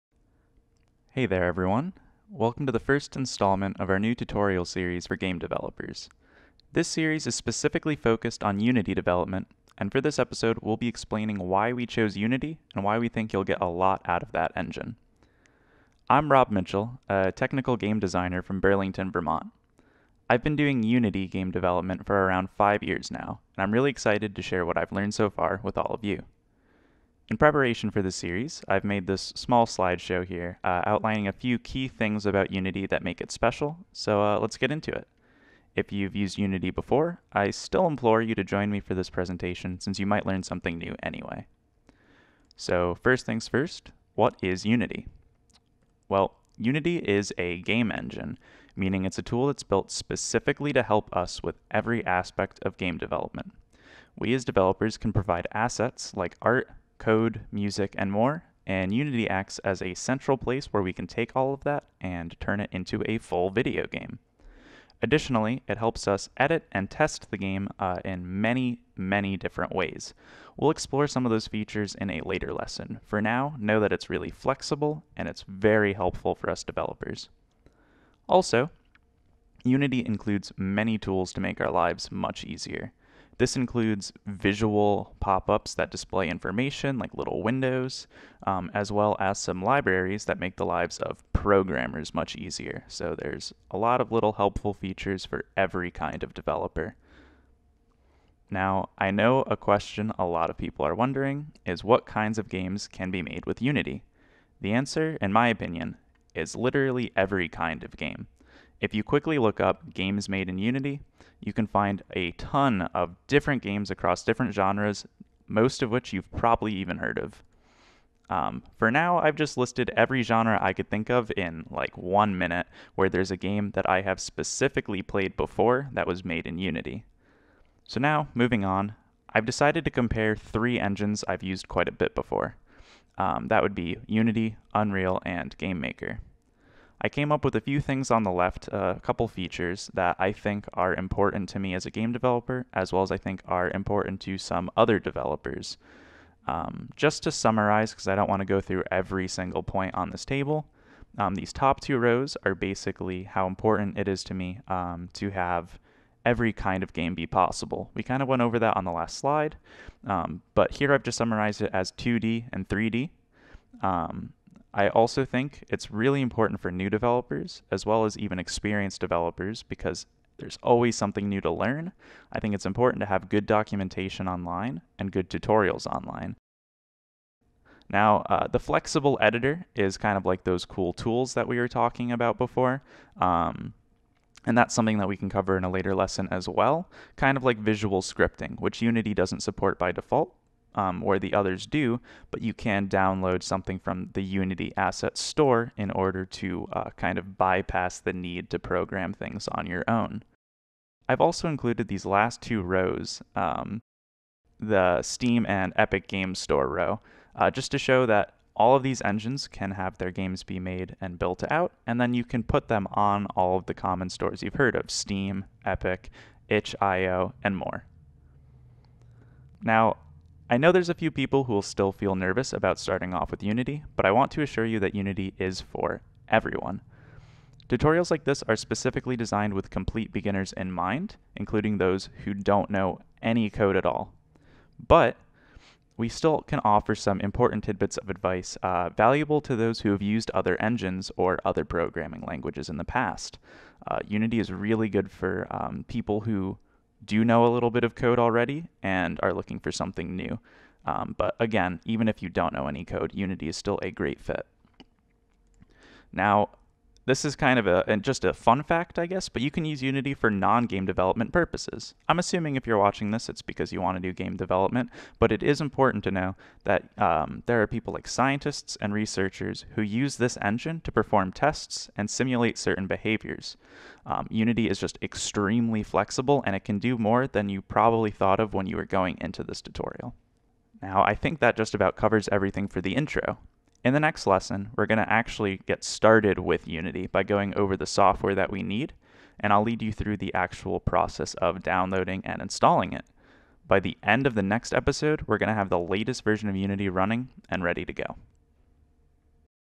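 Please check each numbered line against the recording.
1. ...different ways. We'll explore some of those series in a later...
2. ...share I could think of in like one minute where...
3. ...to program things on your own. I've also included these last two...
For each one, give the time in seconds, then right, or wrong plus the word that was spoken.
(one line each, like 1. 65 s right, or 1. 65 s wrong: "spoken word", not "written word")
1. 69 s wrong: "features", not "series"
2. 120 s wrong: "genre", not "share"
3. 198 s right.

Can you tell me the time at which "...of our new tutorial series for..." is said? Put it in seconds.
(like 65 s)
3 s.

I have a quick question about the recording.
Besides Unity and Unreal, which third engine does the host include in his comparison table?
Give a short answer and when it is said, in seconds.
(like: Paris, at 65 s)
GameMaker, at 135 s.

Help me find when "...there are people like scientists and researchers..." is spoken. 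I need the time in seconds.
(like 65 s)
267 s.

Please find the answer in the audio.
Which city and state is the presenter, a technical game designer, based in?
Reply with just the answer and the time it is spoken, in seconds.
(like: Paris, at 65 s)
Burlington, Vermont, at 18 s.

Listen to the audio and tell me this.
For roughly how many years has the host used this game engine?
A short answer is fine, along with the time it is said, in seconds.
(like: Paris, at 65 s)
5, at 22 s.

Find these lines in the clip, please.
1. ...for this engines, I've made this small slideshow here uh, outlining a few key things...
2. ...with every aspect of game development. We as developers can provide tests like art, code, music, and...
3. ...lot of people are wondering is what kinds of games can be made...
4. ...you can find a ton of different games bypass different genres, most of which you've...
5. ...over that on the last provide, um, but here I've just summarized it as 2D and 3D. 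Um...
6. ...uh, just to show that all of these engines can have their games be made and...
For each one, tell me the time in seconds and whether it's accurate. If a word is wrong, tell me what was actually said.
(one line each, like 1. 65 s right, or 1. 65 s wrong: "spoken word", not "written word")
1. 27 s wrong: "series", not "engines"
2. 51 s wrong: "assets", not "tests"
3. 100 s right
4. 111 s wrong: "across", not "bypass"
5. 158 s wrong: "slide", not "provide"
6. 207 s right.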